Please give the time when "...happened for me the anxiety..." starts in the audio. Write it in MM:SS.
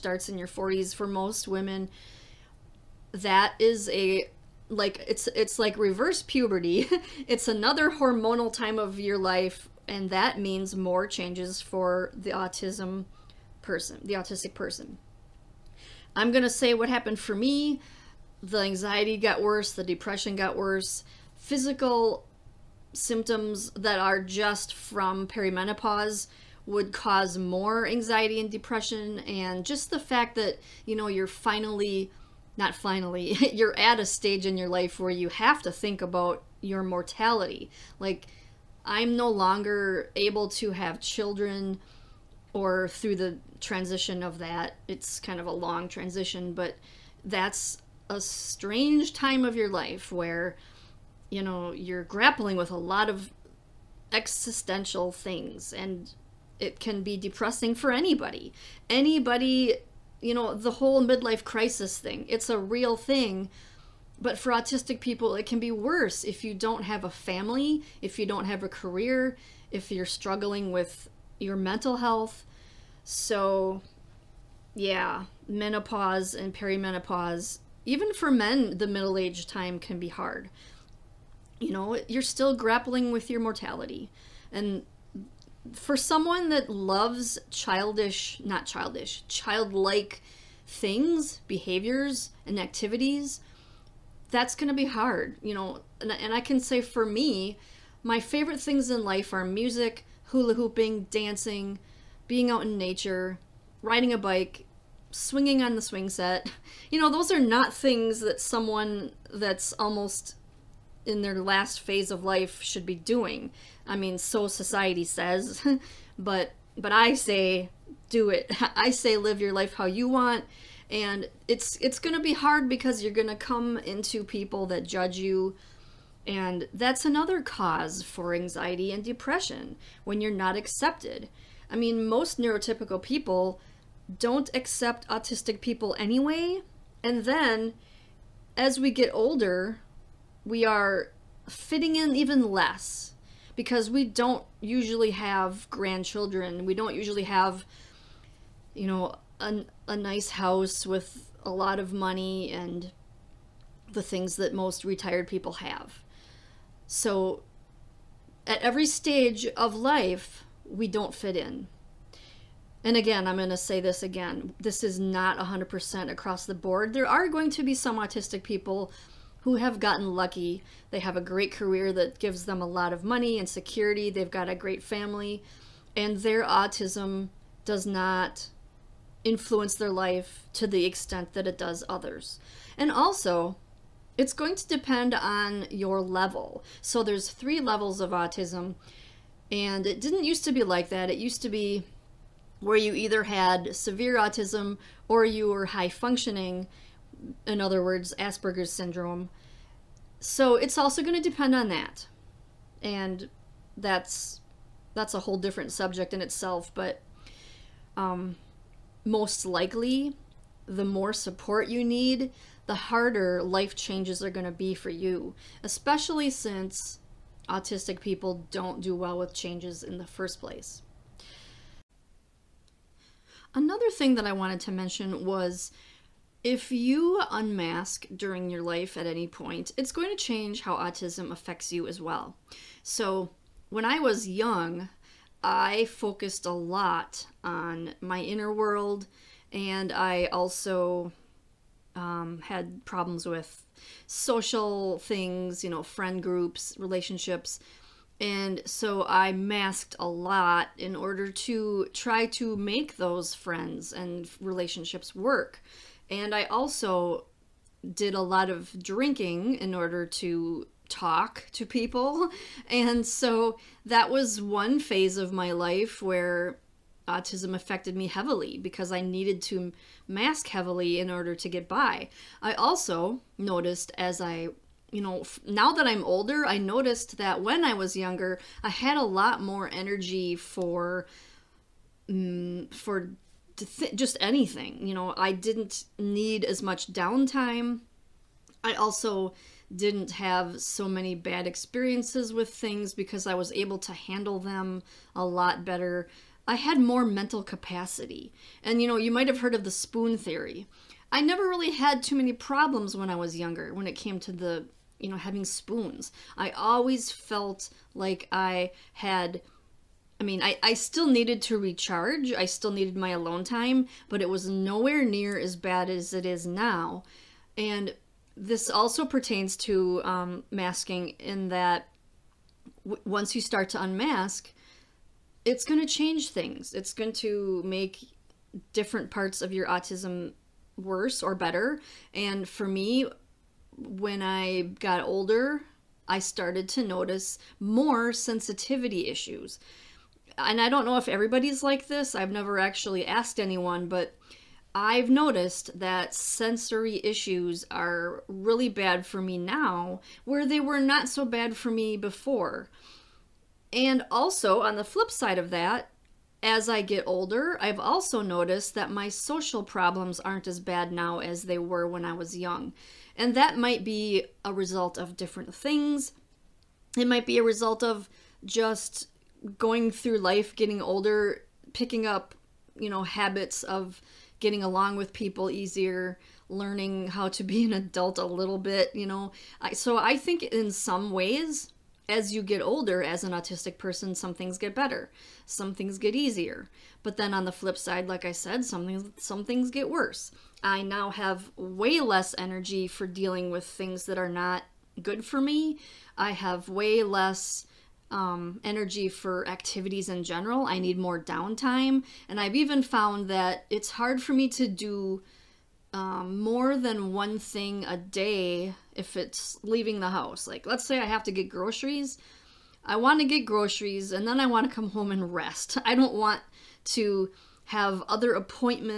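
00:16.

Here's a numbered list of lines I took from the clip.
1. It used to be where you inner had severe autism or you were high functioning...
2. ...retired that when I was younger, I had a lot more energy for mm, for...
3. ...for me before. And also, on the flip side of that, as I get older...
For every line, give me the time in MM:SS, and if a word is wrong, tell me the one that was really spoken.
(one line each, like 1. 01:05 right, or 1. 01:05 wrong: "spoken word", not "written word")
1. 03:11 wrong: "either", not "inner"
2. 04:36 wrong: "noticed", not "retired"
3. 05:51 right.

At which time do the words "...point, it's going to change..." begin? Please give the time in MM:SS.
03:49.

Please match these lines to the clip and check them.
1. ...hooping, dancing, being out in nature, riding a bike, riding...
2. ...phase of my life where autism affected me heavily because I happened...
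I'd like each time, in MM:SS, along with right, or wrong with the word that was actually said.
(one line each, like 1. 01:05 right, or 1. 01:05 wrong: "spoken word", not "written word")
1. 01:40 wrong: "swinging", not "riding"
2. 04:24 wrong: "needed", not "happened".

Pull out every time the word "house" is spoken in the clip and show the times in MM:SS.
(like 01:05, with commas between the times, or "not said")
02:30, 06:50.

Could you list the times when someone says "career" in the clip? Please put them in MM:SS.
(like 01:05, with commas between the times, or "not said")
01:08, 02:51.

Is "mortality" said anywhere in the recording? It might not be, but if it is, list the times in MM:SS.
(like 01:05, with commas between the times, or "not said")
00:36, 01:23.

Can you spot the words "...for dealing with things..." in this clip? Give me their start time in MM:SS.
06:32.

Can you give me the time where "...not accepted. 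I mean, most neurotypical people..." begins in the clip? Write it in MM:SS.
02:10.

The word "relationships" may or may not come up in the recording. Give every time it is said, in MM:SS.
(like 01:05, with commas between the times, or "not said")
04:06, 04:14.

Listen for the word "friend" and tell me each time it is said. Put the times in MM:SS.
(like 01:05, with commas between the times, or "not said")
04:05, 04:13.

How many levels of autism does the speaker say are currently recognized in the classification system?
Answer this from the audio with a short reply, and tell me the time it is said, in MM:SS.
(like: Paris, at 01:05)
3, at 03:07.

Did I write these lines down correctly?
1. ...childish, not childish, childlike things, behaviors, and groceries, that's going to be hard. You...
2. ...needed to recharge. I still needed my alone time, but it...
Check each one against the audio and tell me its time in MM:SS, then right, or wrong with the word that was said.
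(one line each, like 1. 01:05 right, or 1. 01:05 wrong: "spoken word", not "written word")
1. 01:27 wrong: "activities", not "groceries"
2. 05:11 right.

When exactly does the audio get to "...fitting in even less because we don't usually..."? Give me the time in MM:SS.
02:21.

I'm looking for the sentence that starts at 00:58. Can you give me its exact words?
Anybody, you know, the whole midlife crisis thing, it's a real thing.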